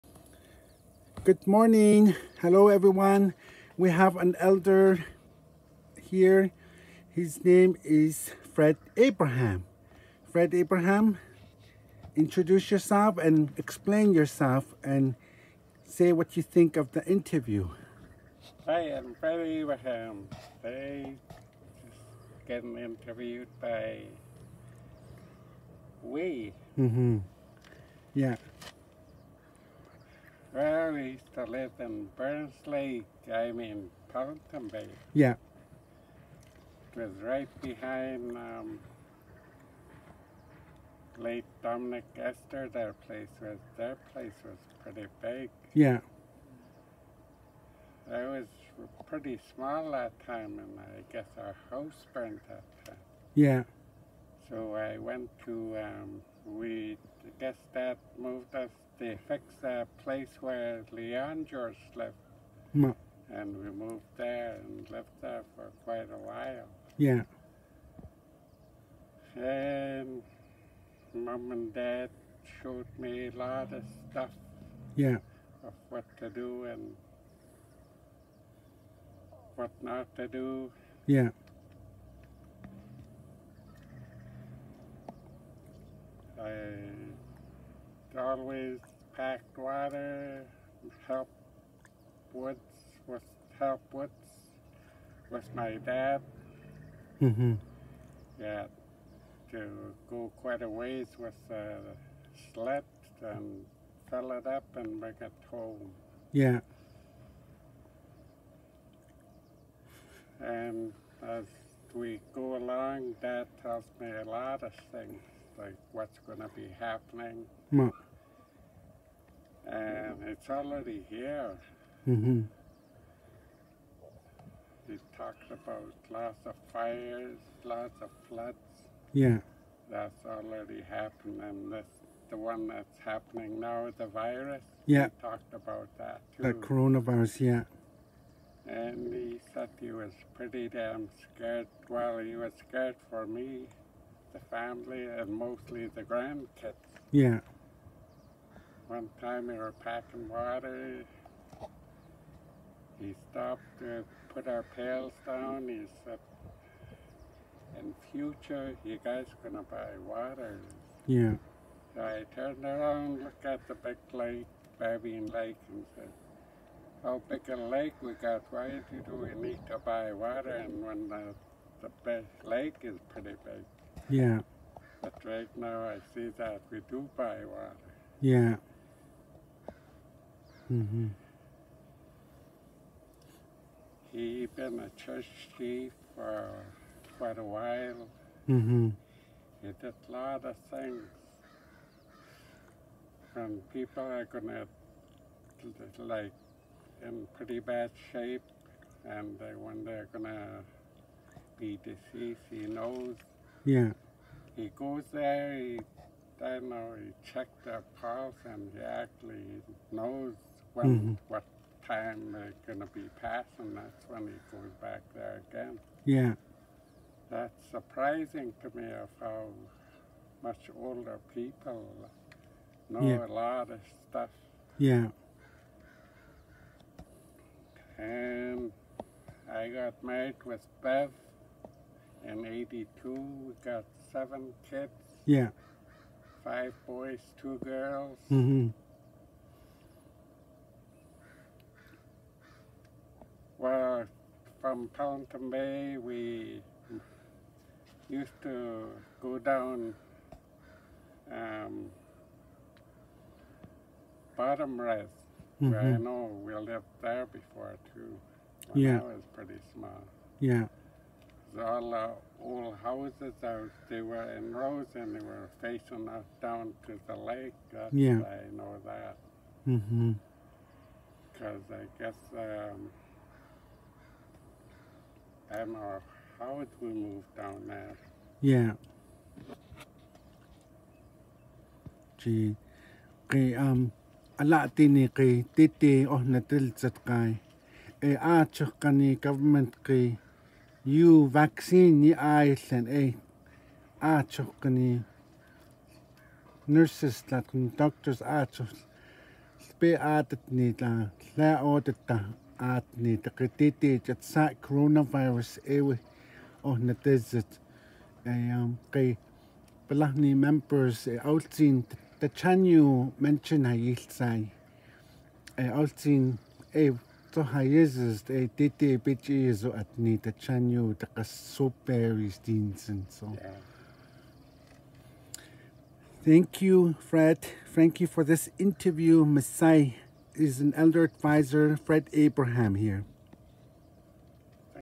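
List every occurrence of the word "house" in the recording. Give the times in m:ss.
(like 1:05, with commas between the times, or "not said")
0:51, 4:22.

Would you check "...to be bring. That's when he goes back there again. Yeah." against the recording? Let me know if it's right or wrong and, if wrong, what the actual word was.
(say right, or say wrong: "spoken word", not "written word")
wrong: "passing", not "bring".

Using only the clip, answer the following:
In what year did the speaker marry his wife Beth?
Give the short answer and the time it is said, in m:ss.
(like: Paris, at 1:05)
1982, at 3:52.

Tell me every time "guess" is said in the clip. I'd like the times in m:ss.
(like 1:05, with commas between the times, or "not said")
0:51, 0:57, 4:32.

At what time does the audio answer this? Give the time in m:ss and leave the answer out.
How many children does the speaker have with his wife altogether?
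3:54.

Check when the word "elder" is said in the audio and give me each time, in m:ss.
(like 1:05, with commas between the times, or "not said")
0:04, 5:30.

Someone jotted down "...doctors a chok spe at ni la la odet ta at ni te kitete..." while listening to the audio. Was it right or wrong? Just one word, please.
right.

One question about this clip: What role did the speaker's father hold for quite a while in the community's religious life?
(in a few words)
church chief.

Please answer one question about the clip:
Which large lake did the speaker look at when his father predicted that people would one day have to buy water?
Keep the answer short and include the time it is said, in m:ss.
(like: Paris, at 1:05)
Babine Lake, at 2:44.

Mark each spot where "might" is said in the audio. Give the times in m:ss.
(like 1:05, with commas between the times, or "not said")
not said.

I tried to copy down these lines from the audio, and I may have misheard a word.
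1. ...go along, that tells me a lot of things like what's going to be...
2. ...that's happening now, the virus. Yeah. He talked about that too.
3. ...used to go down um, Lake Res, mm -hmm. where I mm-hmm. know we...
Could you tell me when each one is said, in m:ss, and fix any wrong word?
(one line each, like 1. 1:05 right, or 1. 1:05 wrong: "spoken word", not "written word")
1. 1:52 right
2. 2:12 right
3. 4:08 wrong: "Bottom", not "Lake".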